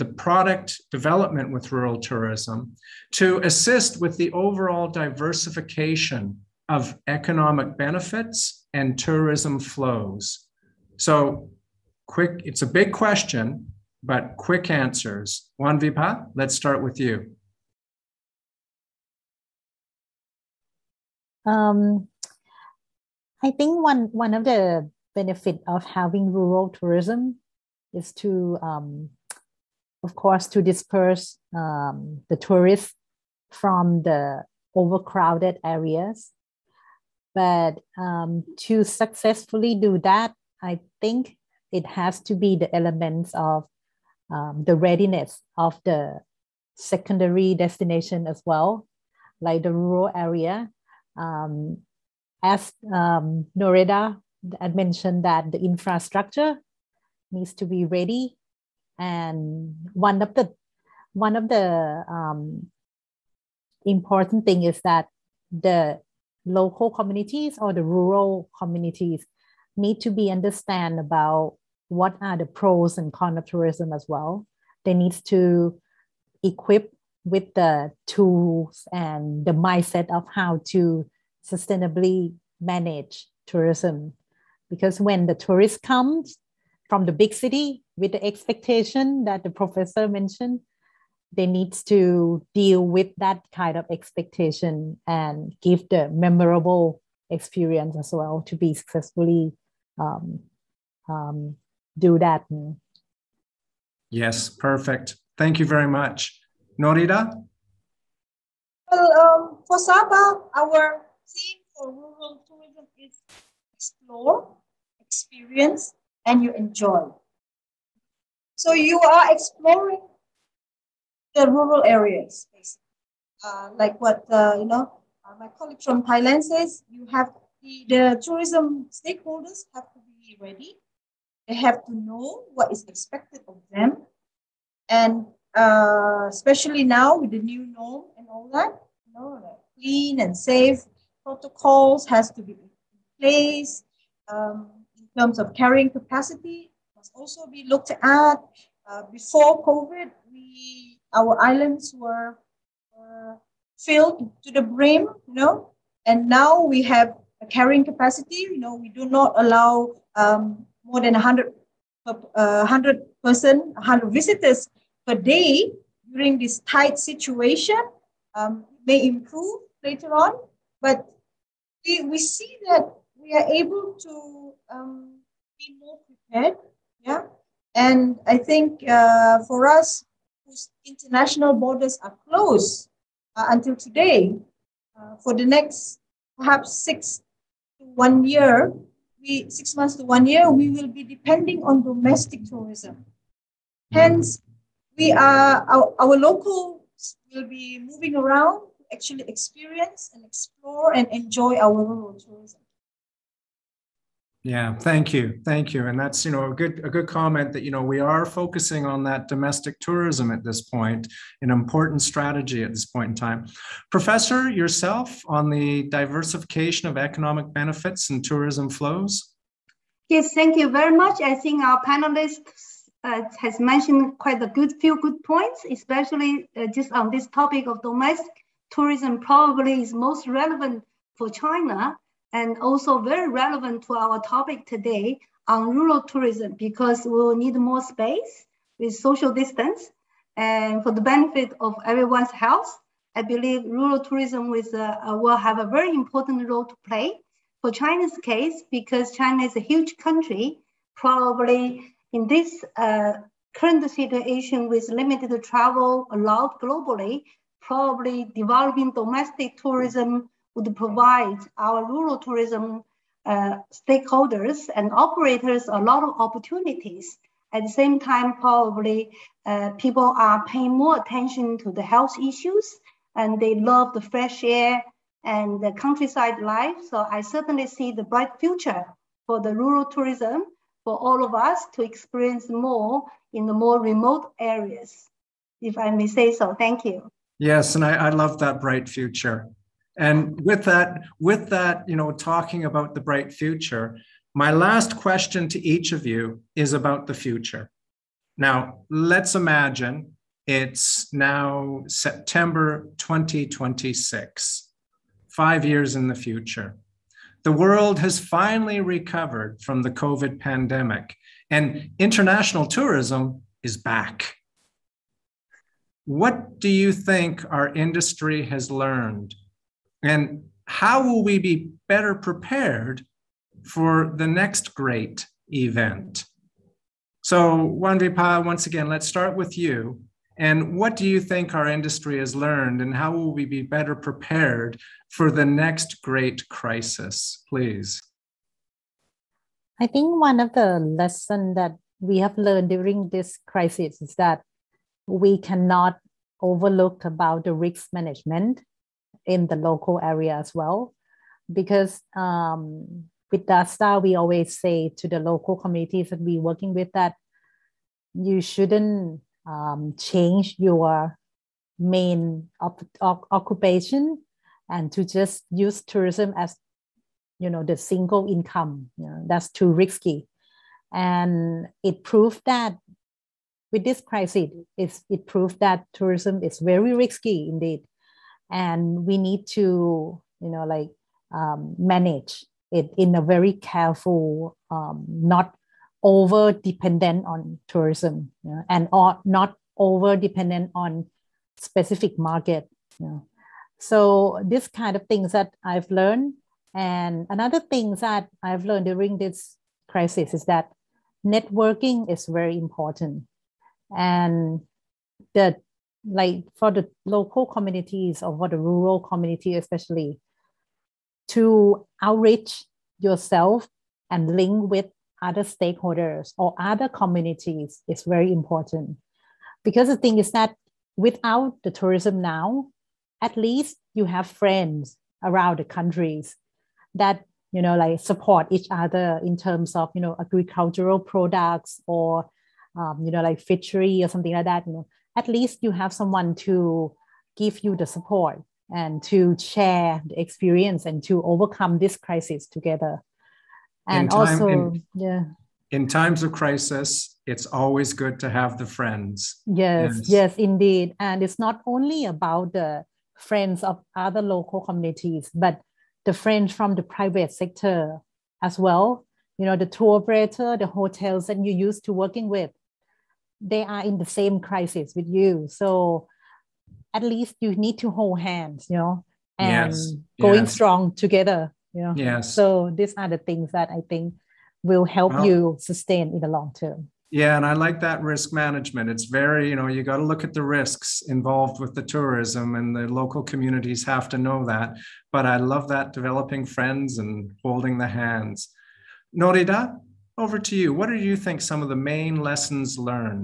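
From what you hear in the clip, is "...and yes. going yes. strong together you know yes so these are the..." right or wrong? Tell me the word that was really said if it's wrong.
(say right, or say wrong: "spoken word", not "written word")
right.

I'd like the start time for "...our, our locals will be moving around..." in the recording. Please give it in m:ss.
3:15.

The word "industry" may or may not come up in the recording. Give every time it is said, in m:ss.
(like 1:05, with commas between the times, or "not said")
5:17, 5:31.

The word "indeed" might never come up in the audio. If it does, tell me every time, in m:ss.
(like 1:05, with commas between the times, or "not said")
6:17, 7:30.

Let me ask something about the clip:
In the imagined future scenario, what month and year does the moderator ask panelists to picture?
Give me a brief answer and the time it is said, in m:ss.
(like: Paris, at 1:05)
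September 2026, at 5:01.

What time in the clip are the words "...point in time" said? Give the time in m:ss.
3:32.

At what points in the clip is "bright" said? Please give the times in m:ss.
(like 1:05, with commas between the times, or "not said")
4:38, 4:48, 4:53.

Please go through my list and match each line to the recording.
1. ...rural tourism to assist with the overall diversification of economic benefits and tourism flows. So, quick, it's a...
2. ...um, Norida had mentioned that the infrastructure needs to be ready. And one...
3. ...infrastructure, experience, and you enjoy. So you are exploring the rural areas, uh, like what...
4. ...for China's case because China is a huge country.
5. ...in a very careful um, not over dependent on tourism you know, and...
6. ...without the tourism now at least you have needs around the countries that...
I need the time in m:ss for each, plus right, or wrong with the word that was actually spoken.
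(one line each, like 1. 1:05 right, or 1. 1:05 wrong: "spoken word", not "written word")
1. 0:01 right
2. 0:52 right
3. 1:53 wrong: "explore", not "infrastructure"
4. 4:07 right
5. 6:22 right
6. 7:00 wrong: "friends", not "needs".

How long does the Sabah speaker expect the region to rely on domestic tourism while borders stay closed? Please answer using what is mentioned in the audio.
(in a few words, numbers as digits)
Six months to one year.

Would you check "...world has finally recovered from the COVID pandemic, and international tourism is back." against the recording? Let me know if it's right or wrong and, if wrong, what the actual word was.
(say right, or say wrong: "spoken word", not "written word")
right.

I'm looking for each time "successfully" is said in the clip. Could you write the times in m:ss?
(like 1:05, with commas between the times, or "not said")
0:38, 1:38.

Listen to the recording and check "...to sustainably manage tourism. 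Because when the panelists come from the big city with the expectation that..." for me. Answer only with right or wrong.
wrong.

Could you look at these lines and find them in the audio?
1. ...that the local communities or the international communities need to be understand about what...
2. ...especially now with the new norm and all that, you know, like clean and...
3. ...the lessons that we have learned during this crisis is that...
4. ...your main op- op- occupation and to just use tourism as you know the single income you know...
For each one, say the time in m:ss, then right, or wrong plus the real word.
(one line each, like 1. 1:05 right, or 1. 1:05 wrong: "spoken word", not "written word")
1. 1:04 wrong: "rural", not "international"
2. 2:16 right
3. 5:40 right
4. 6:00 right.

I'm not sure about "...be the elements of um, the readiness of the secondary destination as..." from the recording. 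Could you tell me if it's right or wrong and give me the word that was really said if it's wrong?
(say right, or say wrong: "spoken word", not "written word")
right.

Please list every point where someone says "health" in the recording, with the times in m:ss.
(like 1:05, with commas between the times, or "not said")
4:02, 4:31.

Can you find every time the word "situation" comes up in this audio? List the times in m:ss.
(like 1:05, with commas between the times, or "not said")
2:46, 4:13.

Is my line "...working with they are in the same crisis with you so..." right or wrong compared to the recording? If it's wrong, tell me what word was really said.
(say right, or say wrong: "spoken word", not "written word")
right.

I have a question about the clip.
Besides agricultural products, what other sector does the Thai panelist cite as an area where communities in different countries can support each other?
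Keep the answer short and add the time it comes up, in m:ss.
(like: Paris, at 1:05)
Fishery, at 7:13.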